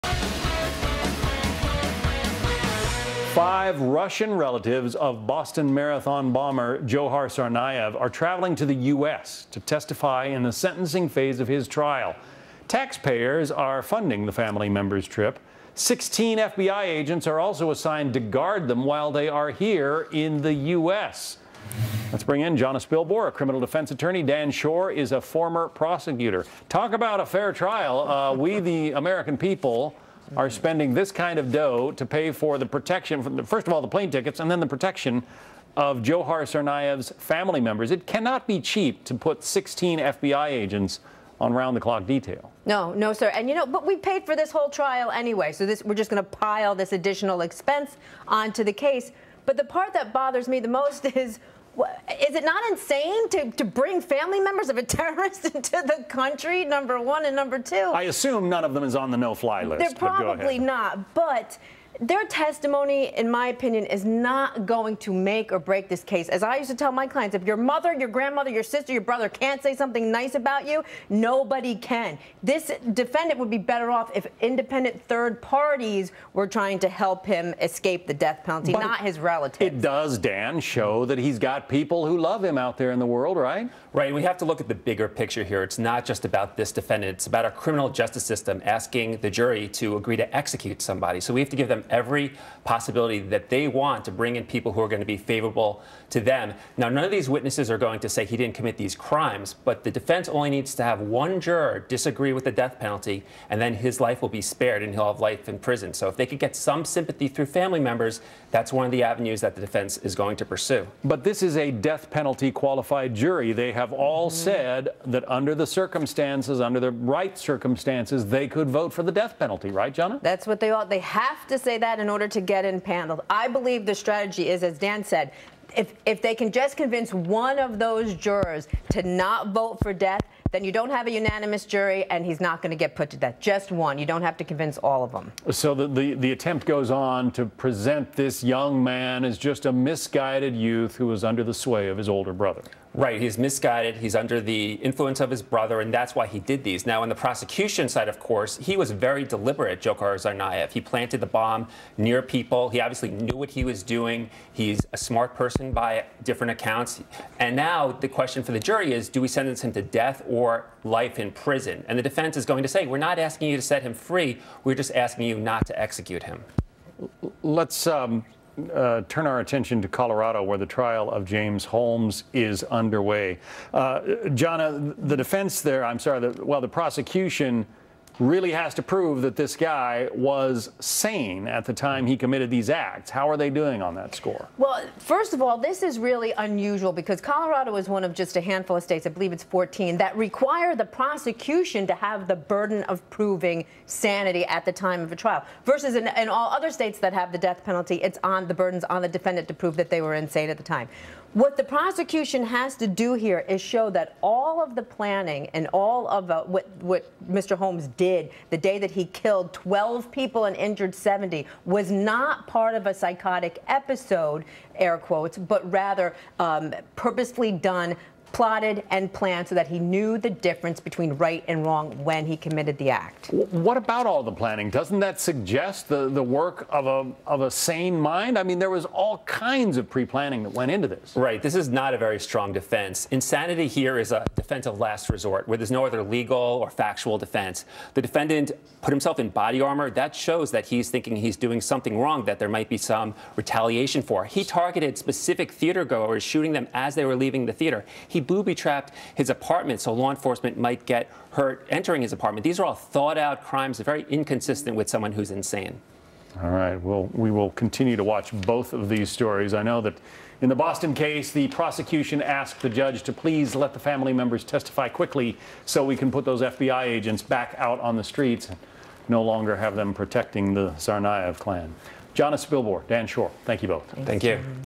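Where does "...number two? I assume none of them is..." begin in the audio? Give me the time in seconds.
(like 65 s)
57 s.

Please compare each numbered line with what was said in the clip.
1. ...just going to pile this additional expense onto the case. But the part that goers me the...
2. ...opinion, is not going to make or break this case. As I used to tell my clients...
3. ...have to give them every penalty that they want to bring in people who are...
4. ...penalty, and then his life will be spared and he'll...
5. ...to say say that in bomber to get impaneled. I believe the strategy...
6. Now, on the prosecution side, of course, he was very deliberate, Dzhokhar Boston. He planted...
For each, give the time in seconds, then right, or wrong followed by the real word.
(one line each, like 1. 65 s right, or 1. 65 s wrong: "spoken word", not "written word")
1. 45 s wrong: "bothers", not "goers"
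2. 63 s right
3. 91 s wrong: "possibility", not "penalty"
4. 102 s right
5. 121 s wrong: "order", not "bomber"
6. 146 s wrong: "Tsarnaev", not "Boston".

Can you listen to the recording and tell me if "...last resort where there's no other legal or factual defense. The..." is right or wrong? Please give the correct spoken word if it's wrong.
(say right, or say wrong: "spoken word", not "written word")
right.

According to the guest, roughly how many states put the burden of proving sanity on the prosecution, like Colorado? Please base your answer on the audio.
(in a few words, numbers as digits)
14.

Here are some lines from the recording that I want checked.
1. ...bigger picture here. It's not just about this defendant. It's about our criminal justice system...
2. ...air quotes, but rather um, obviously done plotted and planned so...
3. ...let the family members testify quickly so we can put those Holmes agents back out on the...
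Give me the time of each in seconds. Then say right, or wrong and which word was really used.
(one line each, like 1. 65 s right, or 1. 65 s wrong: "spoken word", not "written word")
1. 84 s right
2. 214 s wrong: "purposely", not "obviously"
3. 263 s wrong: "FBI", not "Holmes".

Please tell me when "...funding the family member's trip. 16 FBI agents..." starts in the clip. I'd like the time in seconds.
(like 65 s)
13 s.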